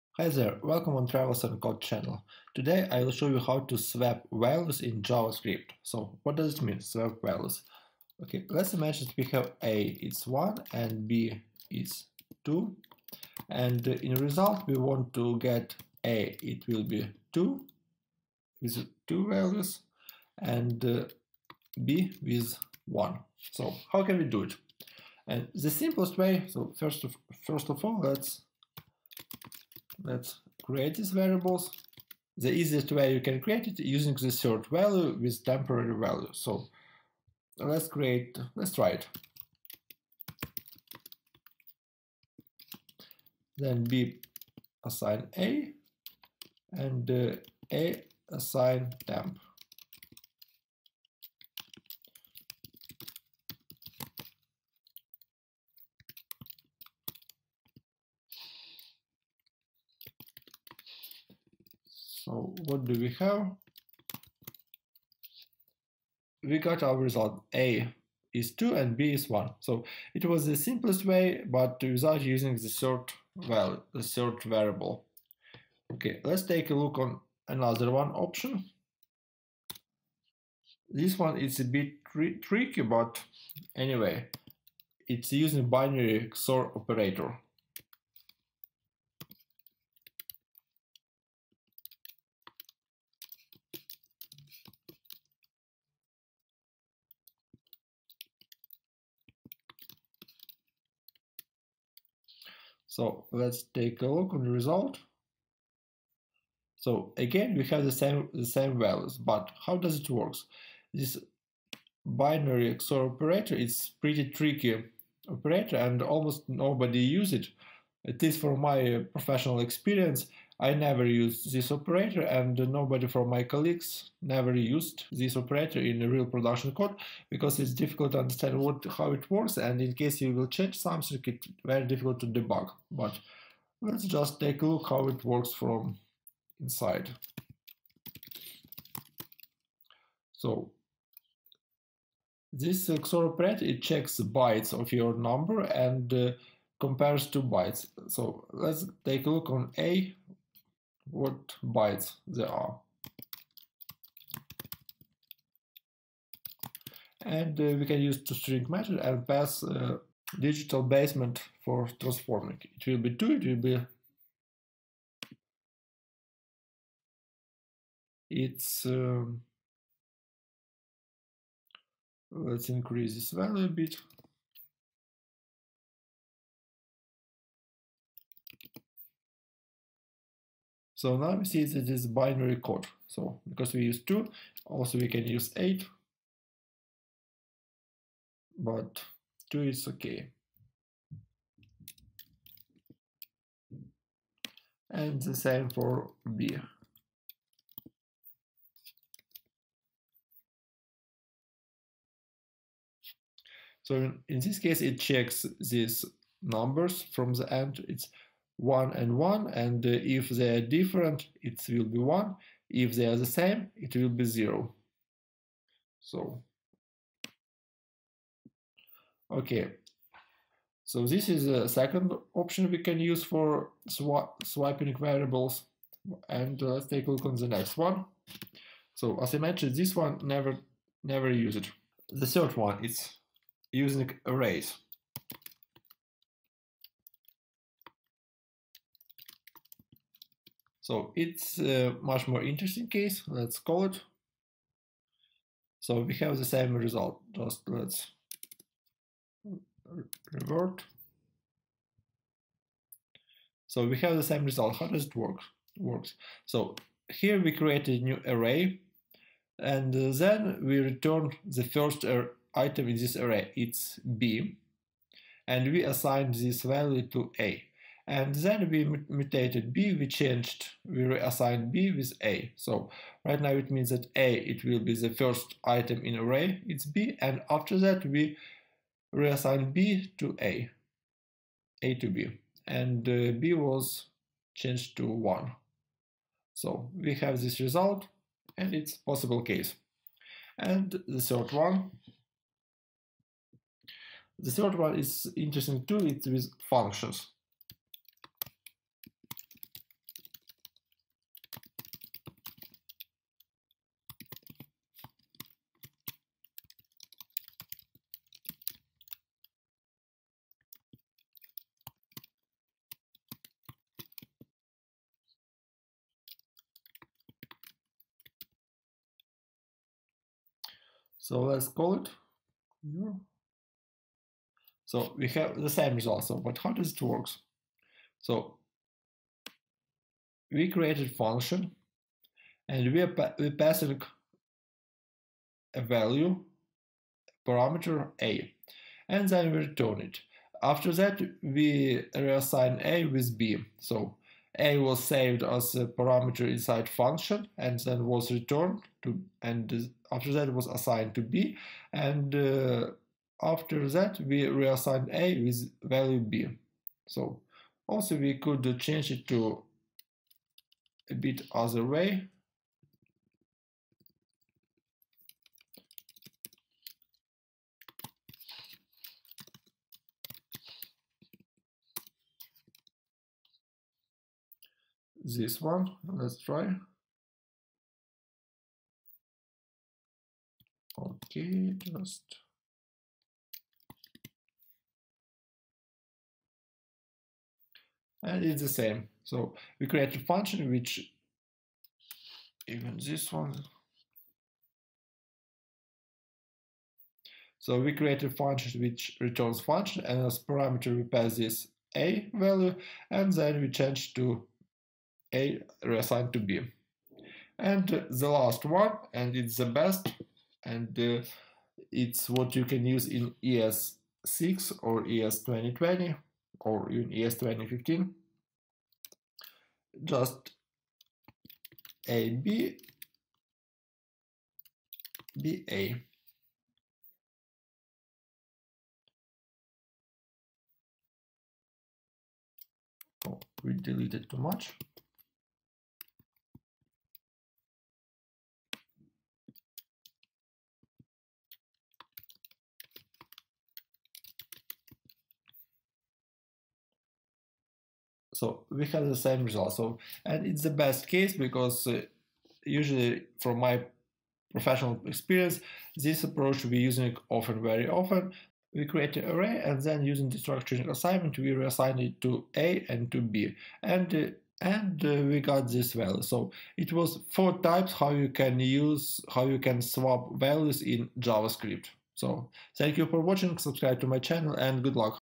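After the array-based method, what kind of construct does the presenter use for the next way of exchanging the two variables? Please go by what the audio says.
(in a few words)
Functions.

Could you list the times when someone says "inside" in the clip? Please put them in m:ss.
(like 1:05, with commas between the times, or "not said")
2:16, 5:46.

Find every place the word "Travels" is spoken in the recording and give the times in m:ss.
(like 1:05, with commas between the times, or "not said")
0:01.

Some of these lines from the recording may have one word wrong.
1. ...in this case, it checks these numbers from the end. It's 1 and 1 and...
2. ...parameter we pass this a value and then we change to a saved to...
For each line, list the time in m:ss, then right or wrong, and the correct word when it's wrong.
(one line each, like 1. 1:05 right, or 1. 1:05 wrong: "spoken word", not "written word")
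1. 3:24 right
2. 6:40 wrong: "reassigned", not "saved".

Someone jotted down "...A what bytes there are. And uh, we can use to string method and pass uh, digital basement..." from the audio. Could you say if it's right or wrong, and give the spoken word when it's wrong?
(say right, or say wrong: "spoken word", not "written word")
right.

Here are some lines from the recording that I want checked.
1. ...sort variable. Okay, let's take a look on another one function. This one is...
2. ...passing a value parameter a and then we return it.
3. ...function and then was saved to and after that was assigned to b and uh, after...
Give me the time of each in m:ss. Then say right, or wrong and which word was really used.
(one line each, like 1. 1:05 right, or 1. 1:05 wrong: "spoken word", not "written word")
1. 1:14 wrong: "option", not "function"
2. 5:33 right
3. 5:46 wrong: "returned", not "saved".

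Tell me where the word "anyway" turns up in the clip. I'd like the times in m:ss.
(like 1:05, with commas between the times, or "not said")
1:23.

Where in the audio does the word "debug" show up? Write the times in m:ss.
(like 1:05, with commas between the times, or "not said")
2:12.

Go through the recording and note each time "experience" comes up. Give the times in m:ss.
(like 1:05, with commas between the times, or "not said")
1:59, 7:35.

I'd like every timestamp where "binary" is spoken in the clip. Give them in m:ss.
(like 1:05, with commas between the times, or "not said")
1:25, 1:52, 3:02.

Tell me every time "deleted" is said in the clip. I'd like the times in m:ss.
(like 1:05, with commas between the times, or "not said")
7:13.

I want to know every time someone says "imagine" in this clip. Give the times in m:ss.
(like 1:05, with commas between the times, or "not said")
0:08.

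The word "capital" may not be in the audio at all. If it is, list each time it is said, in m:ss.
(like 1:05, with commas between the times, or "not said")
not said.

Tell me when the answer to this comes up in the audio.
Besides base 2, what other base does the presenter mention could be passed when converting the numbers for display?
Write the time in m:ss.
3:04.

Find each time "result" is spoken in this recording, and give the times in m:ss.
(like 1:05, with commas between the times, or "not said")
0:14, 1:06, 1:44, 4:06, 4:14, 4:47, 5:25, 7:29.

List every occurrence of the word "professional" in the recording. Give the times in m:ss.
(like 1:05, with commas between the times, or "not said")
1:59, 7:34.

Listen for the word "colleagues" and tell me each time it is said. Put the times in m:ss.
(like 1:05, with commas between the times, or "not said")
2:03.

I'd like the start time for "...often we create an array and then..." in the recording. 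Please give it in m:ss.
7:37.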